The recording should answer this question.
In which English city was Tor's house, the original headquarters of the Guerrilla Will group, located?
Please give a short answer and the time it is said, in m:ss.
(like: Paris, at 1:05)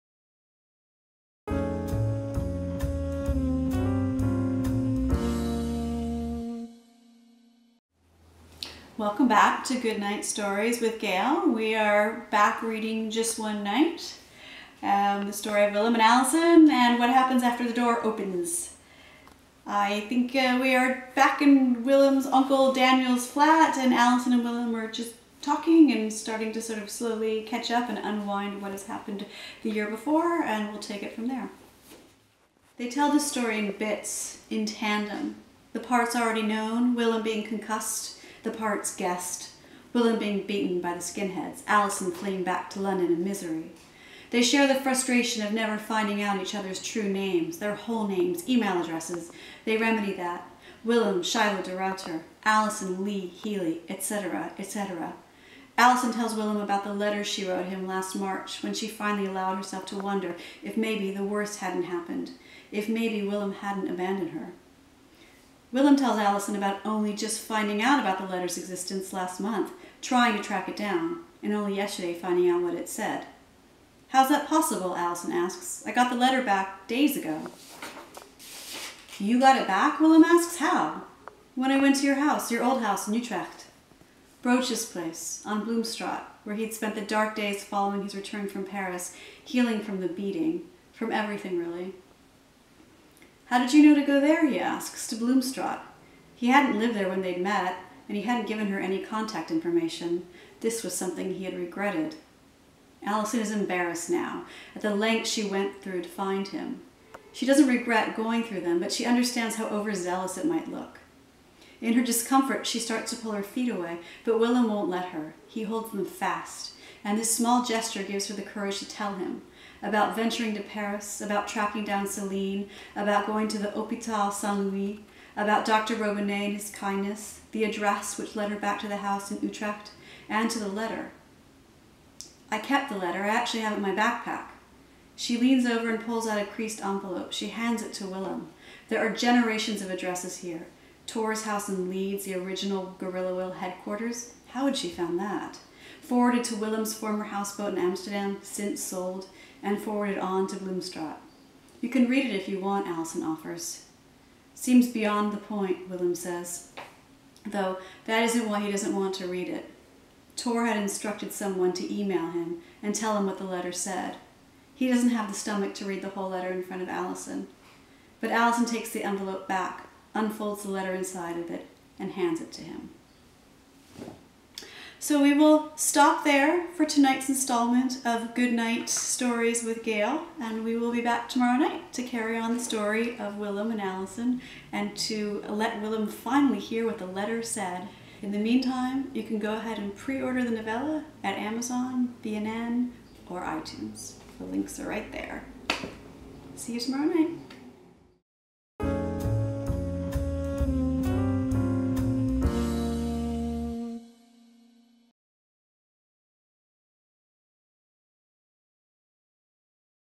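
Leeds, at 2:21.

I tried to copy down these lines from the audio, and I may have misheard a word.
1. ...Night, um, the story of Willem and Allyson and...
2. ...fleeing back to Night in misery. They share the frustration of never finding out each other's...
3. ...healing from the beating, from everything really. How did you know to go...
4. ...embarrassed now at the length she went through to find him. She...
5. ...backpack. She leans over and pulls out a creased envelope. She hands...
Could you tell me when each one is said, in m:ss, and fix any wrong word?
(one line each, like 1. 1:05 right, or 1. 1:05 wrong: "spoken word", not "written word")
1. 0:13 right
2. 0:42 wrong: "London", not "Night"
3. 1:29 right
4. 1:43 right
5. 2:13 right.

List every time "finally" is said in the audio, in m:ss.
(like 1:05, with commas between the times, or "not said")
0:58, 3:06.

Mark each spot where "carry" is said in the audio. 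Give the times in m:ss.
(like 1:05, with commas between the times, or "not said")
3:02.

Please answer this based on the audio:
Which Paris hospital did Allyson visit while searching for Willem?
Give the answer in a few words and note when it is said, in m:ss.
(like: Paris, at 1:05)
Hôpital Saint Louis, at 2:03.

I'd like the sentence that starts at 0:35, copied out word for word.
The parts already known, Willem being concussed, the parts guessed.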